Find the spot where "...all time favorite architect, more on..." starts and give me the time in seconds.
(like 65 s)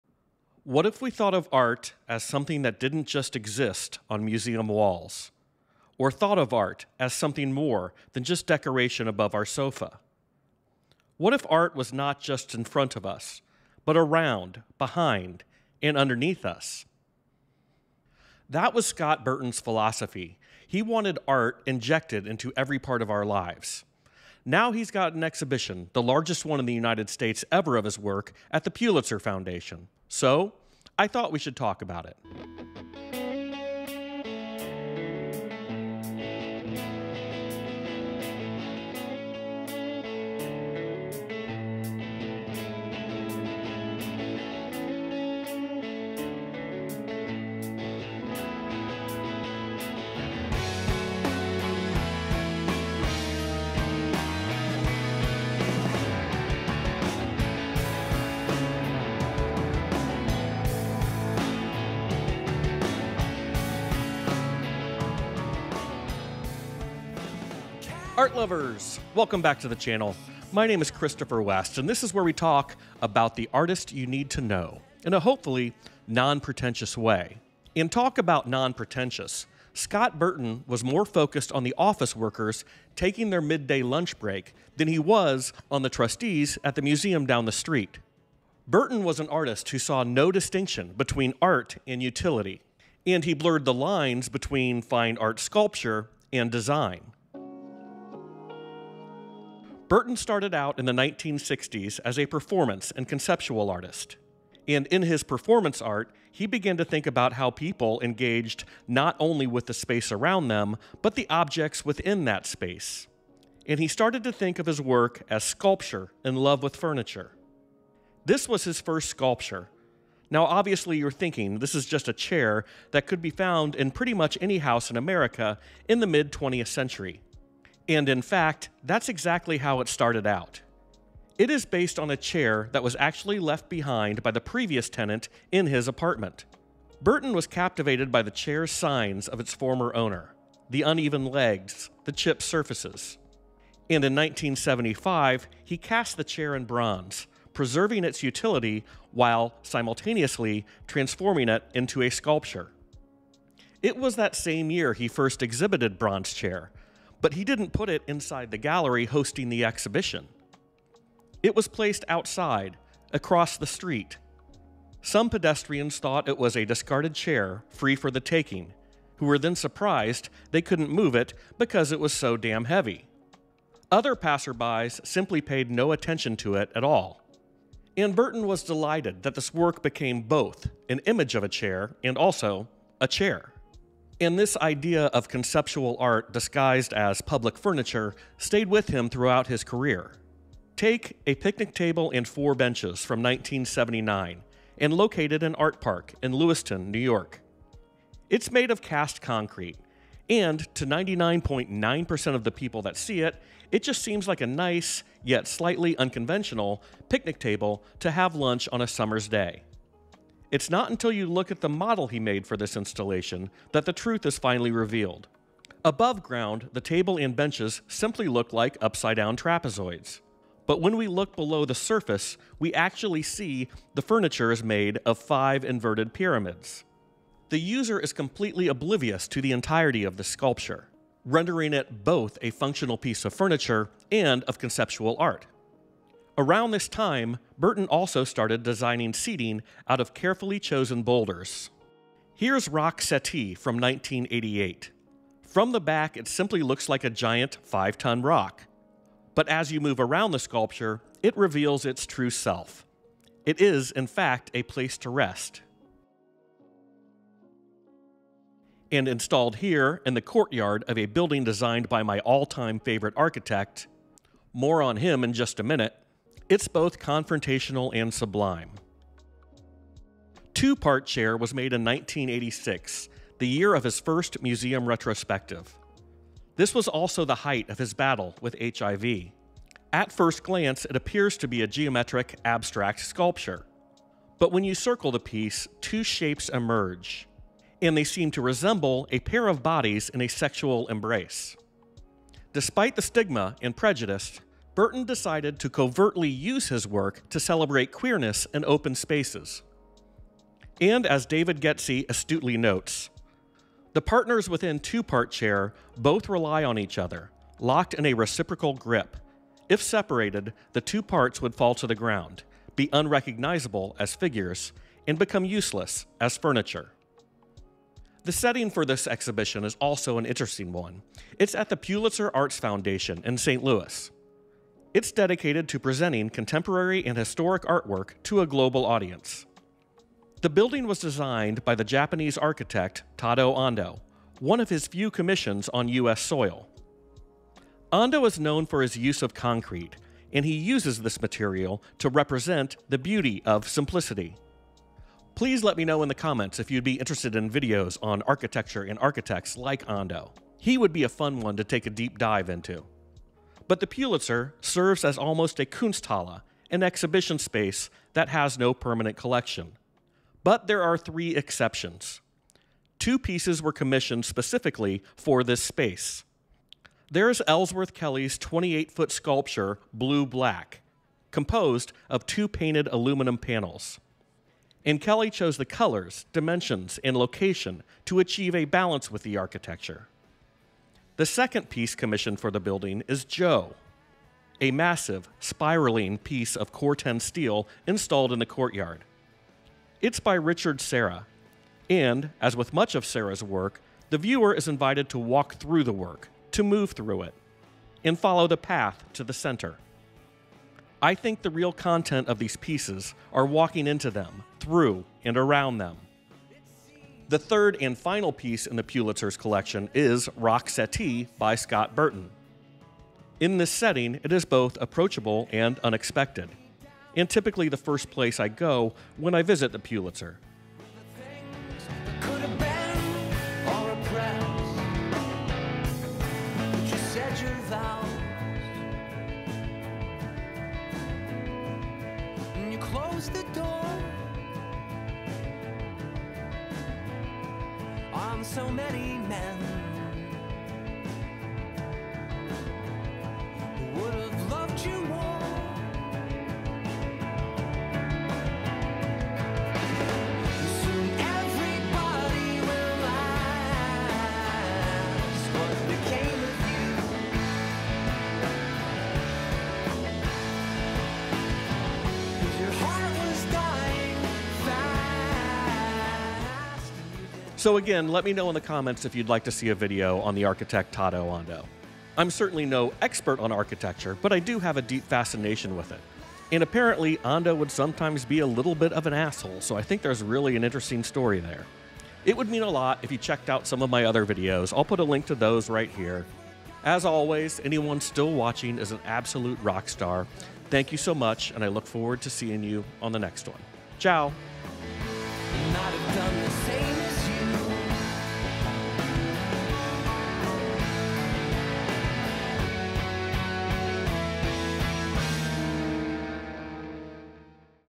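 262 s.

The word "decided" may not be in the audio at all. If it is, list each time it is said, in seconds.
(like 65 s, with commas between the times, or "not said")
295 s.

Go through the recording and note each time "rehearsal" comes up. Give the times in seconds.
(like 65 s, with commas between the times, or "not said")
not said.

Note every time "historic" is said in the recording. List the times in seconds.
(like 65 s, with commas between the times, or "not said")
327 s.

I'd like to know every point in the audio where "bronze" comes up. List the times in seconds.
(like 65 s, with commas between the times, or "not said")
146 s, 155 s.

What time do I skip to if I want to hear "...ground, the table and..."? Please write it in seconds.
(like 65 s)
216 s.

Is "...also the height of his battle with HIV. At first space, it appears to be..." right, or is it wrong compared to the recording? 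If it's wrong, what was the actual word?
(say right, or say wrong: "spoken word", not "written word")
wrong: "glance", not "space".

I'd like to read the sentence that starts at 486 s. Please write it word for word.
As always, anyone still watching is an absolute rock star.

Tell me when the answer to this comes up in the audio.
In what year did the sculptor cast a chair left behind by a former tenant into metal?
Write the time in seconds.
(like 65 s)
144 s.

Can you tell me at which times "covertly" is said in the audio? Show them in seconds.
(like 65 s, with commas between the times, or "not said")
295 s.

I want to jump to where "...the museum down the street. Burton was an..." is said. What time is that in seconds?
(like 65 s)
86 s.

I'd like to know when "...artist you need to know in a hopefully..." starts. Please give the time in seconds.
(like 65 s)
73 s.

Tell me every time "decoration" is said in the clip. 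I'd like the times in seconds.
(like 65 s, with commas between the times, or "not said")
8 s.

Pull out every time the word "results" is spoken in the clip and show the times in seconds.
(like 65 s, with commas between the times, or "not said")
not said.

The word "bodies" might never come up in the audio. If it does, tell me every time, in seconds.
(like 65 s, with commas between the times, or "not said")
289 s.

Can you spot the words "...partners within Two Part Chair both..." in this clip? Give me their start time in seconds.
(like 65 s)
304 s.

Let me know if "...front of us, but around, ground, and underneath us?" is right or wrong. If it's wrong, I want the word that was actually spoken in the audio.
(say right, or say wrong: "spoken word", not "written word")
wrong: "behind", not "ground".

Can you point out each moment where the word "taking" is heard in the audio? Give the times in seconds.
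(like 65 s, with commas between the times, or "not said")
82 s, 168 s.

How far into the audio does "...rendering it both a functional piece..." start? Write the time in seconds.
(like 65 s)
231 s.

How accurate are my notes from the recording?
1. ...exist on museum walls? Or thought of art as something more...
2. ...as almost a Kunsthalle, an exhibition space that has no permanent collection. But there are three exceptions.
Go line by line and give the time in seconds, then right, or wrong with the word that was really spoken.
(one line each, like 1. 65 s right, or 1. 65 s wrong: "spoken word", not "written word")
1. 3 s right
2. 355 s right.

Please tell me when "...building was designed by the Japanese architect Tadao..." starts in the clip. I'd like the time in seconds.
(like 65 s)
330 s.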